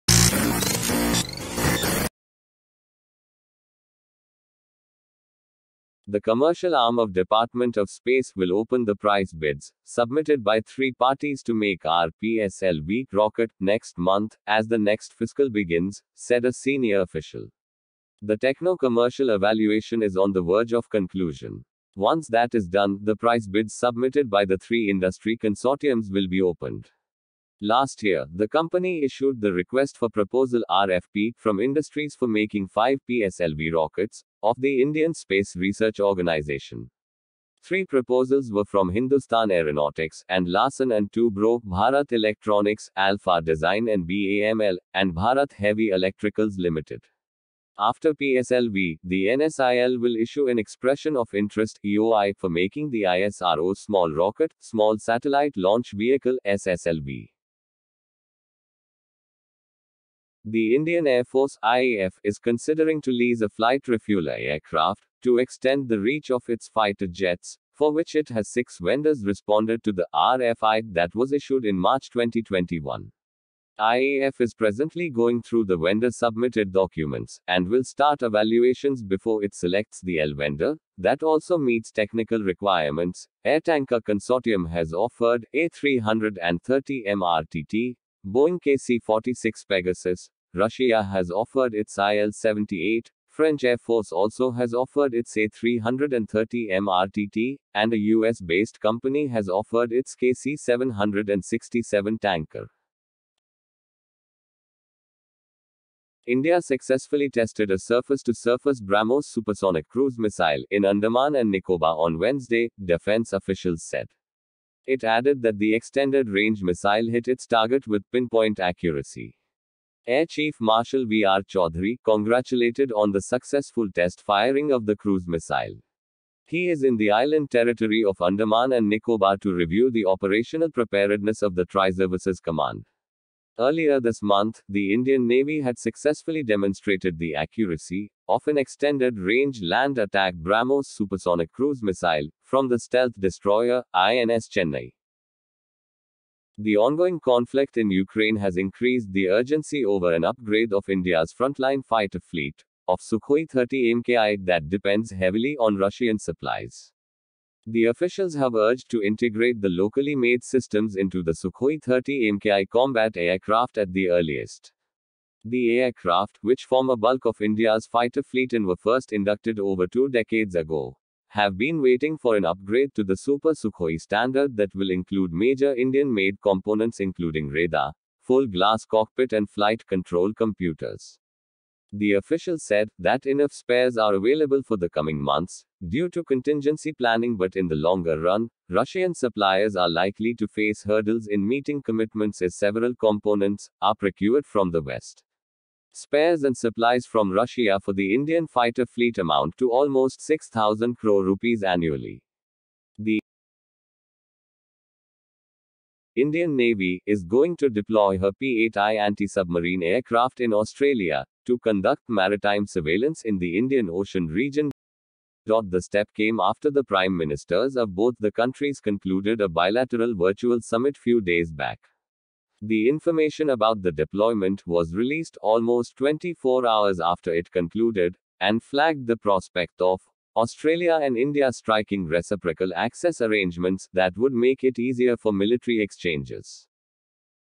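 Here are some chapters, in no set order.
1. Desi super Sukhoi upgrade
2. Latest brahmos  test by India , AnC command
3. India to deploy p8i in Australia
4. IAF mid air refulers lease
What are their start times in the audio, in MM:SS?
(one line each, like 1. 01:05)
1. 02:27
2. 01:44
3. 03:25
4. 00:58.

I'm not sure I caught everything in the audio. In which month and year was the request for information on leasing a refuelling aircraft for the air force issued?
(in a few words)
March 2021.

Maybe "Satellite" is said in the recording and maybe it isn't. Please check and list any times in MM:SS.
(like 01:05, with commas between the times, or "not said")
00:54.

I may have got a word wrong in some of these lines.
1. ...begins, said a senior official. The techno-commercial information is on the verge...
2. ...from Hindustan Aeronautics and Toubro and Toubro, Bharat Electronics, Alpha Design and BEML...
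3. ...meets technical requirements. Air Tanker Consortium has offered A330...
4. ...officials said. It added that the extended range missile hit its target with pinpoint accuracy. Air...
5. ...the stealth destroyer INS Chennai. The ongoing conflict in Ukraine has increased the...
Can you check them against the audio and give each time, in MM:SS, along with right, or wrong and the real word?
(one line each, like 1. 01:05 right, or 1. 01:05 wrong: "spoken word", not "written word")
1. 00:15 wrong: "evaluation", not "information"
2. 00:38 wrong: "Larsen", not "Toubro"
3. 01:21 right
4. 01:53 right
5. 02:22 right.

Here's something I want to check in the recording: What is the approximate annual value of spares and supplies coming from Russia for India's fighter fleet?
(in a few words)
6,000 crore rupees.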